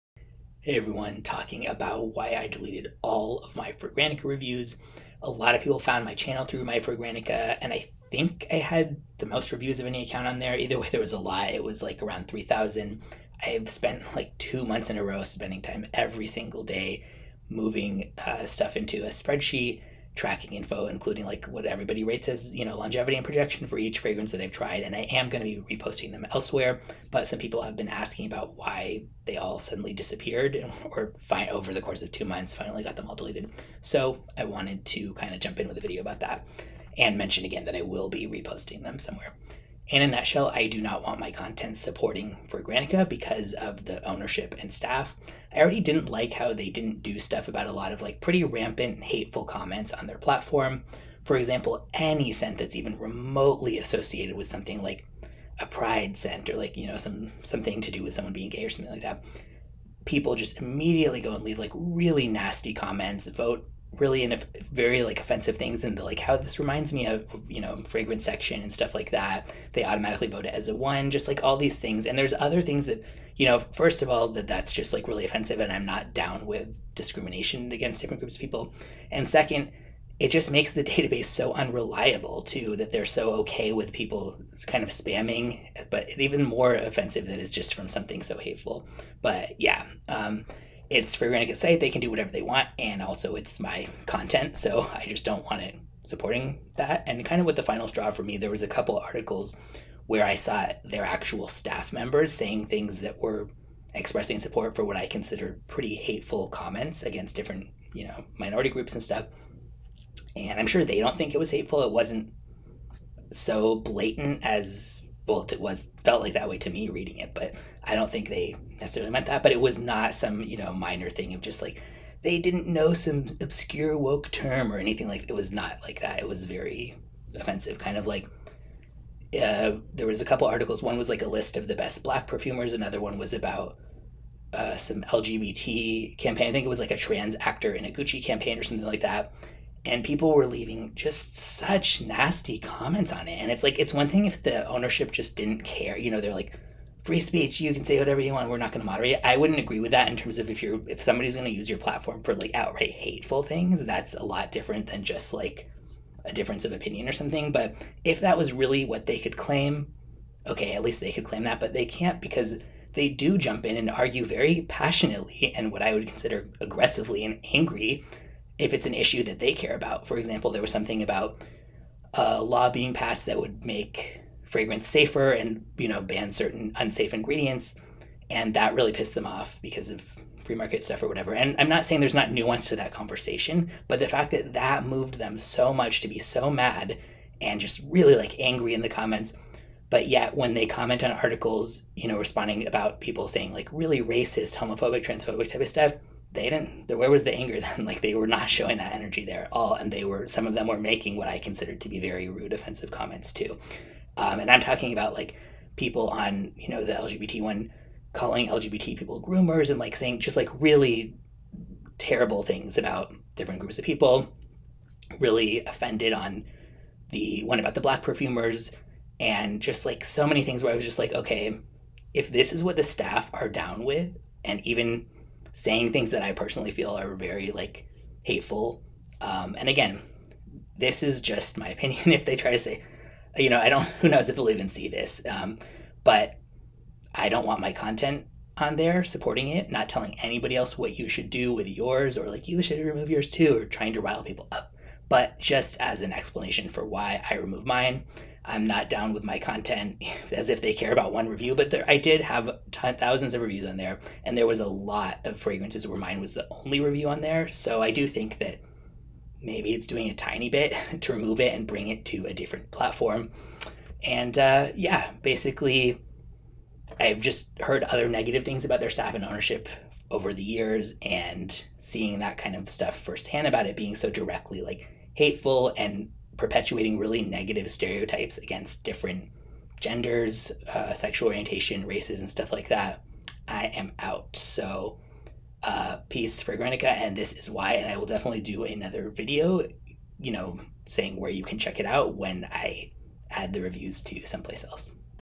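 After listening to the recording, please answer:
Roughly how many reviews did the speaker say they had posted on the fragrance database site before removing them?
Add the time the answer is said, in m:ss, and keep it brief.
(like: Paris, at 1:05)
3,000, at 0:12.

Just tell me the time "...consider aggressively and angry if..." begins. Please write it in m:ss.
2:46.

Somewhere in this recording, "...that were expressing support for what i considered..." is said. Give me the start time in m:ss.
1:42.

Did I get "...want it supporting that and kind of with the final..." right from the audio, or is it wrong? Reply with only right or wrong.
right.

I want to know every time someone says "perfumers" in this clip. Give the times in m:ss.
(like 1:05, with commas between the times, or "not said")
2:12, 3:38.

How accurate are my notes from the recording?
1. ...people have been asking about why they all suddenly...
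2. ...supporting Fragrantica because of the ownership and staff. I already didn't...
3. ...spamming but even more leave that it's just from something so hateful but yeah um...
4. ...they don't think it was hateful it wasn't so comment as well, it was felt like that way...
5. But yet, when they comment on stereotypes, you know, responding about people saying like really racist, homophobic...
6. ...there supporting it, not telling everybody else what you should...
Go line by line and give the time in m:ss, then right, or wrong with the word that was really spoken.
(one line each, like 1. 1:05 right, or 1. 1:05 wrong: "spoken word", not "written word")
1. 0:27 right
2. 0:41 right
3. 1:24 wrong: "offensive", not "leave"
4. 1:50 wrong: "blatant", not "comment"
5. 3:09 wrong: "articles", not "stereotypes"
6. 3:58 wrong: "anybody", not "everybody".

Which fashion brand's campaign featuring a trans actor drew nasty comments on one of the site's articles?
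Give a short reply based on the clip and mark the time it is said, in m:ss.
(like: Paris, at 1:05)
Gucci, at 2:17.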